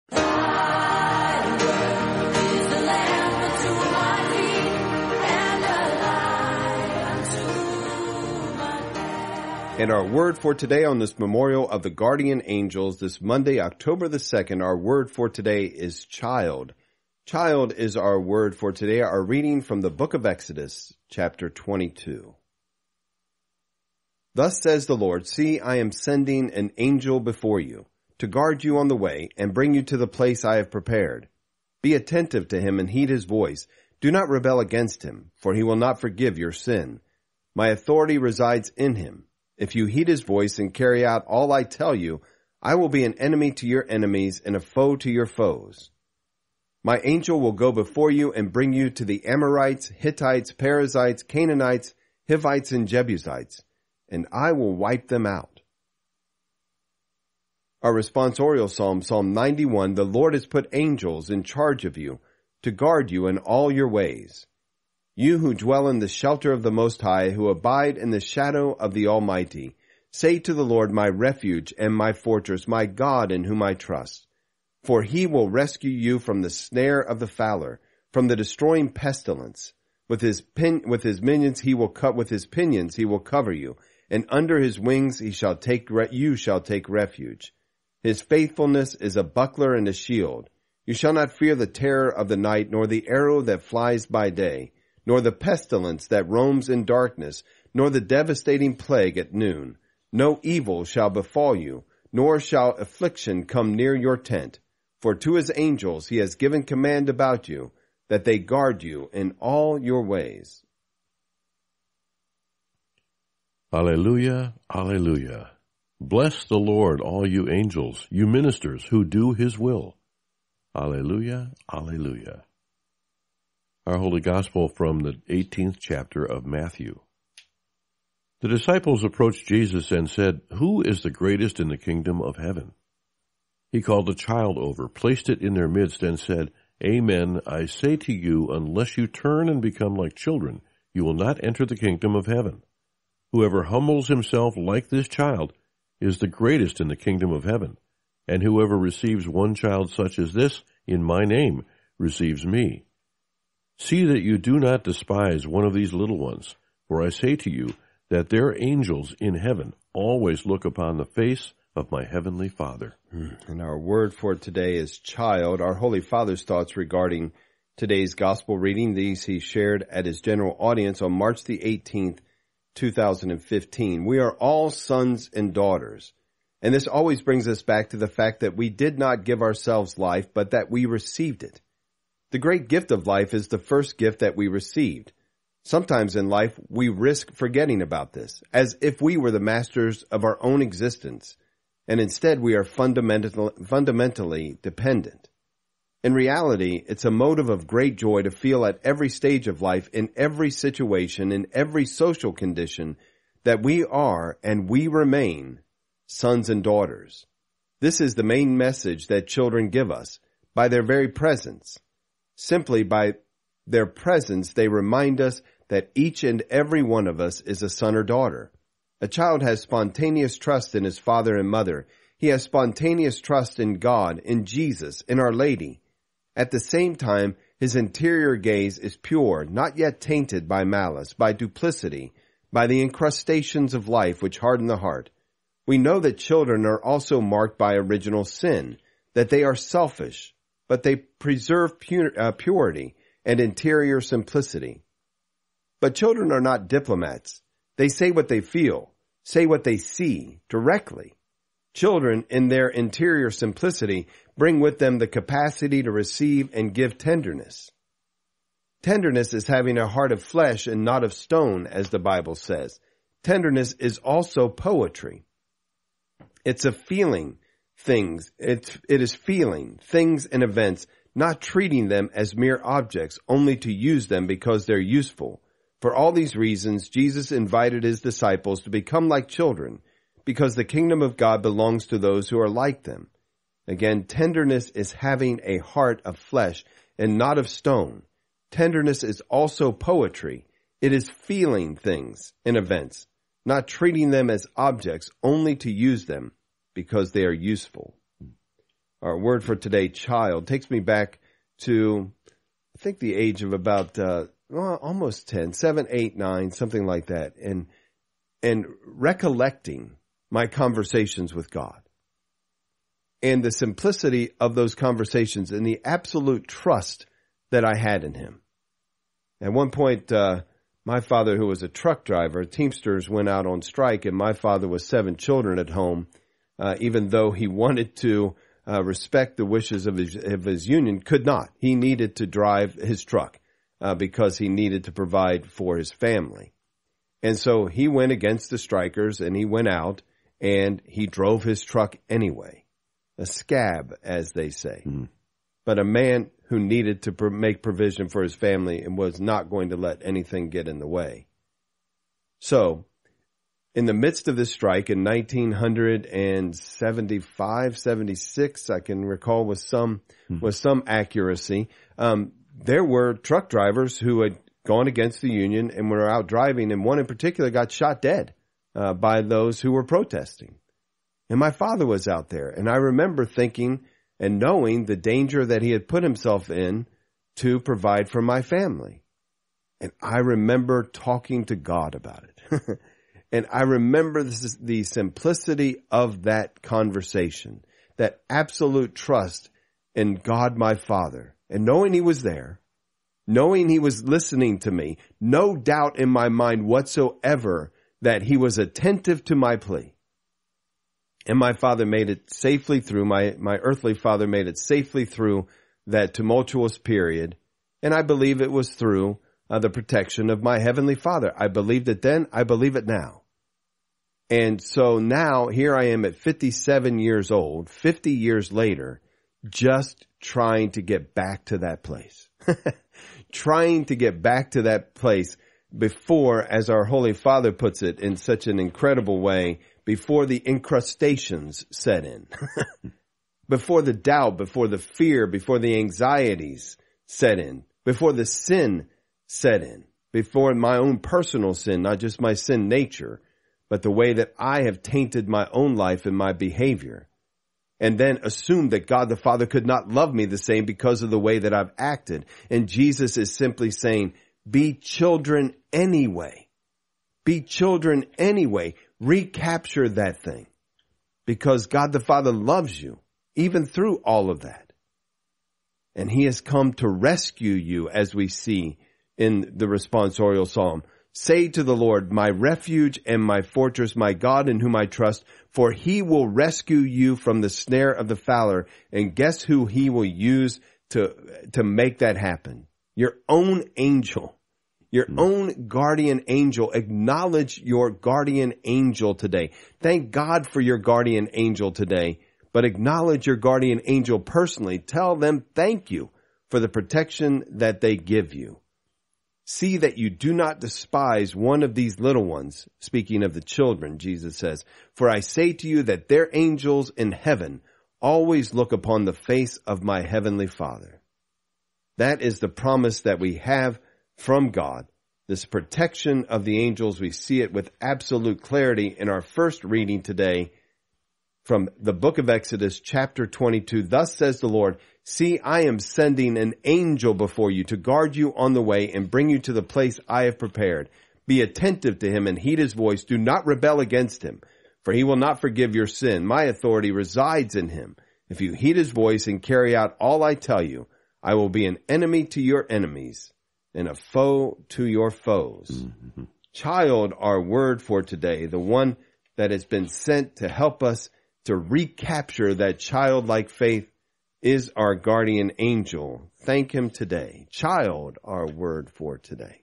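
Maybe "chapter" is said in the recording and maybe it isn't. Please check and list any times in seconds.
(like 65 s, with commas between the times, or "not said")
21 s, 125 s, 522 s.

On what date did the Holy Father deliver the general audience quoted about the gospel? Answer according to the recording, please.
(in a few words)
March 18, 2015.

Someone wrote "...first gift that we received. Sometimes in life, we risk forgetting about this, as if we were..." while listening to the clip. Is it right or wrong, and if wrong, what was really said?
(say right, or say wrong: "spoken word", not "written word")
right.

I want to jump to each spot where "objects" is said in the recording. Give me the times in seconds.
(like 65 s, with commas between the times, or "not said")
272 s, 294 s.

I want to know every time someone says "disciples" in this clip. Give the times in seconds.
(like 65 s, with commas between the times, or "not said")
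128 s, 278 s.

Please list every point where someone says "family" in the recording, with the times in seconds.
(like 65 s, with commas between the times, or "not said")
335 s, 348 s, 378 s.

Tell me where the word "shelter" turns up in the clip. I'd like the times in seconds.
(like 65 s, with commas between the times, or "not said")
66 s.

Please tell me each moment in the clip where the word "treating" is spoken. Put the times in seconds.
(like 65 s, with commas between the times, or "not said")
271 s, 293 s.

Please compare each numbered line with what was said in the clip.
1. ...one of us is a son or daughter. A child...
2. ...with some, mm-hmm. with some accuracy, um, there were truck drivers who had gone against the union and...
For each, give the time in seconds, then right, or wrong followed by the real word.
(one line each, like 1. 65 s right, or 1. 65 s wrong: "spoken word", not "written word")
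1. 216 s right
2. 359 s right.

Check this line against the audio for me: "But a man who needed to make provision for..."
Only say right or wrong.
right.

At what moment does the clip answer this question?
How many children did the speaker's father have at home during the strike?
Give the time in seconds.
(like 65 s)
324 s.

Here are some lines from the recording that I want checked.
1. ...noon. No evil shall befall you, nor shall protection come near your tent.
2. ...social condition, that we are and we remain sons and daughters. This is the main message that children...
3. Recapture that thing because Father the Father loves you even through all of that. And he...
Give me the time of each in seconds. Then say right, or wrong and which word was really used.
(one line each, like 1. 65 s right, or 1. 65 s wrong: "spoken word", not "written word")
1. 99 s wrong: "affliction", not "protection"
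2. 201 s right
3. 458 s wrong: "God", not "Father".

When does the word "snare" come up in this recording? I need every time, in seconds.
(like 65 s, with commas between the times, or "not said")
76 s, 477 s.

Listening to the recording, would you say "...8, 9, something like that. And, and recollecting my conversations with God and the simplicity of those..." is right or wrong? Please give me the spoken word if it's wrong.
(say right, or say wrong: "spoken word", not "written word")
right.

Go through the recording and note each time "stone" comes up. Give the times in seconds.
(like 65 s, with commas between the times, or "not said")
261 s, 287 s.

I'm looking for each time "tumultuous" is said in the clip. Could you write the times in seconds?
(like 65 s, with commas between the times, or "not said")
406 s.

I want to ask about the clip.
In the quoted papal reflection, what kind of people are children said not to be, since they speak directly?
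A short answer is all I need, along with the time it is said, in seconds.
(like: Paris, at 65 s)
Diplomats, at 246 s.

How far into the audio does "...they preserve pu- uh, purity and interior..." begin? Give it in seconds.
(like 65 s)
240 s.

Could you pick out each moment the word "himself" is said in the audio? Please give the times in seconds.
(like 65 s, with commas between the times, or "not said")
144 s, 376 s.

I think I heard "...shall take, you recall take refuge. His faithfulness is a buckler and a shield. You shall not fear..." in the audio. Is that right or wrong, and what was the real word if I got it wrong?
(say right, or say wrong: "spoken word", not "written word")
wrong: "shall", not "recall".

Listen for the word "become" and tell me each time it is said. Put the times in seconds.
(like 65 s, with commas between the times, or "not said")
139 s, 278 s.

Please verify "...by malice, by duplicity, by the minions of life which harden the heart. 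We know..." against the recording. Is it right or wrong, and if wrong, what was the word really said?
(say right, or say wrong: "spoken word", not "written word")
wrong: "incrustations", not "minions".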